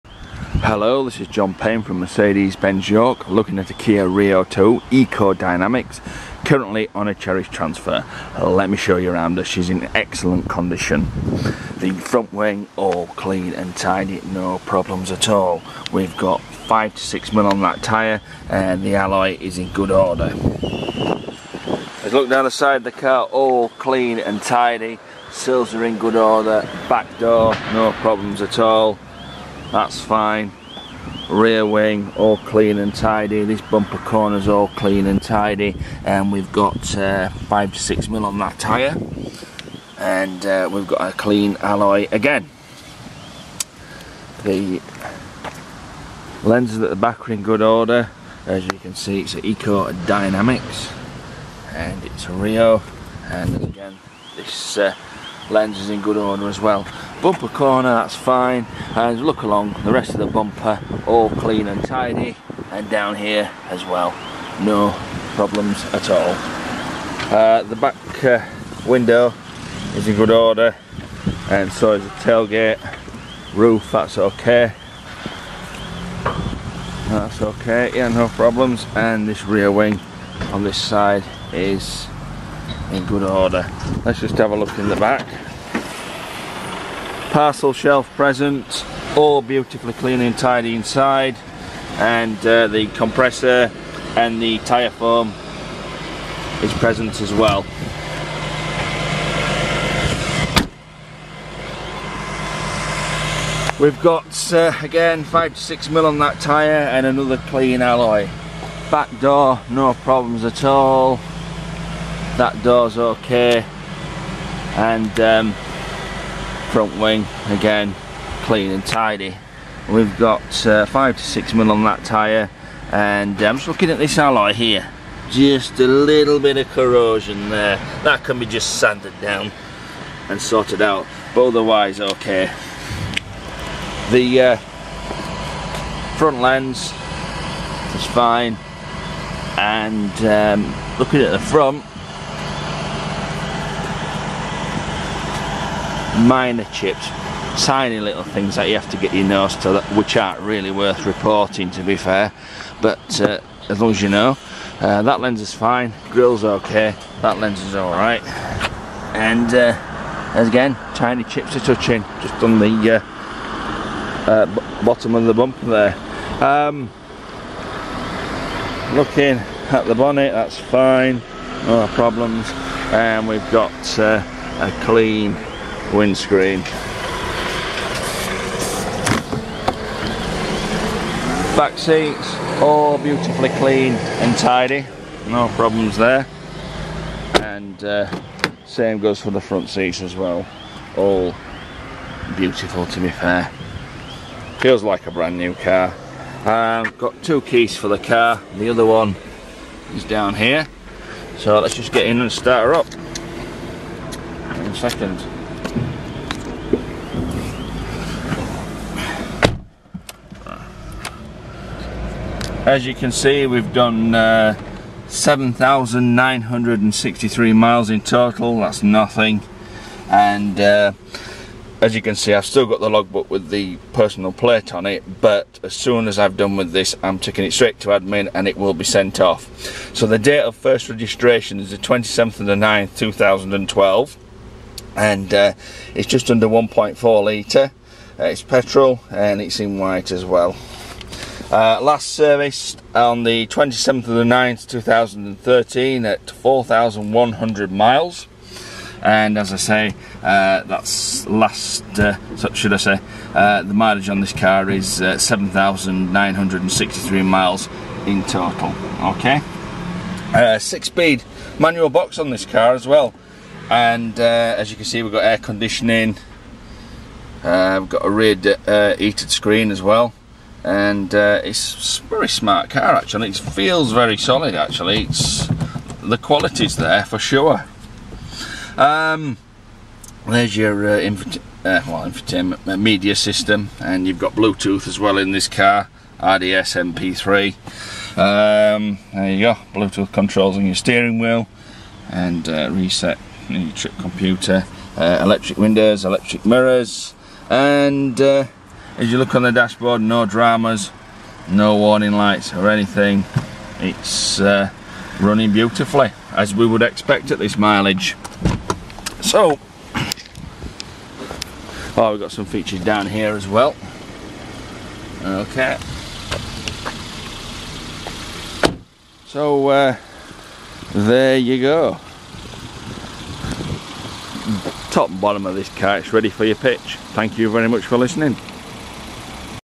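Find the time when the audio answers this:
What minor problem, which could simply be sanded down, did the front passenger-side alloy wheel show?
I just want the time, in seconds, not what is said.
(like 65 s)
126 s.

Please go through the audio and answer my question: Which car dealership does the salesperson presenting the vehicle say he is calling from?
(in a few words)
Mercedes-Benz York.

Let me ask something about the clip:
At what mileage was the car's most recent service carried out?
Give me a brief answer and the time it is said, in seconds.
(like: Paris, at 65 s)
4,100 miles, at 246 s.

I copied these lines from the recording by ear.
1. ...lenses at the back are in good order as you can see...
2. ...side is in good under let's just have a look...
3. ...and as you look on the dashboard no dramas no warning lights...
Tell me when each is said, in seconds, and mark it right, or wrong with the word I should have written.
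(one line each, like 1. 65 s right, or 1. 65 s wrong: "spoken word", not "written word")
1. 46 s right
2. 80 s wrong: "order", not "under"
3. 297 s right.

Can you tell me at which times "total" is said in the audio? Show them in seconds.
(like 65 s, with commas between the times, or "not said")
218 s, 258 s.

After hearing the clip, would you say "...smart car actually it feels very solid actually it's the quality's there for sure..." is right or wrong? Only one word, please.
right.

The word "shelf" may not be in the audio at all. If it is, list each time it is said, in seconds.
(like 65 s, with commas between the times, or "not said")
87 s.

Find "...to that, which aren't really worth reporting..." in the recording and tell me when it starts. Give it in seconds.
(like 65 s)
149 s.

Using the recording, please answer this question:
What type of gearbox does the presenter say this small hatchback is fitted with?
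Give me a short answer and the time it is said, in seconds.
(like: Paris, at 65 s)
six speed manual, at 260 s.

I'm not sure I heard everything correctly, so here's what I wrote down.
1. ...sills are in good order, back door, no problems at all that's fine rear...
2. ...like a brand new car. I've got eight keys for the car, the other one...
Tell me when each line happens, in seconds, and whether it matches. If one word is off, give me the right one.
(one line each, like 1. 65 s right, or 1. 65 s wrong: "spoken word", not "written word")
1. 25 s right
2. 194 s wrong: "two", not "eight".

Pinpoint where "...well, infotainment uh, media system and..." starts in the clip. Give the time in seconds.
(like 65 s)
281 s.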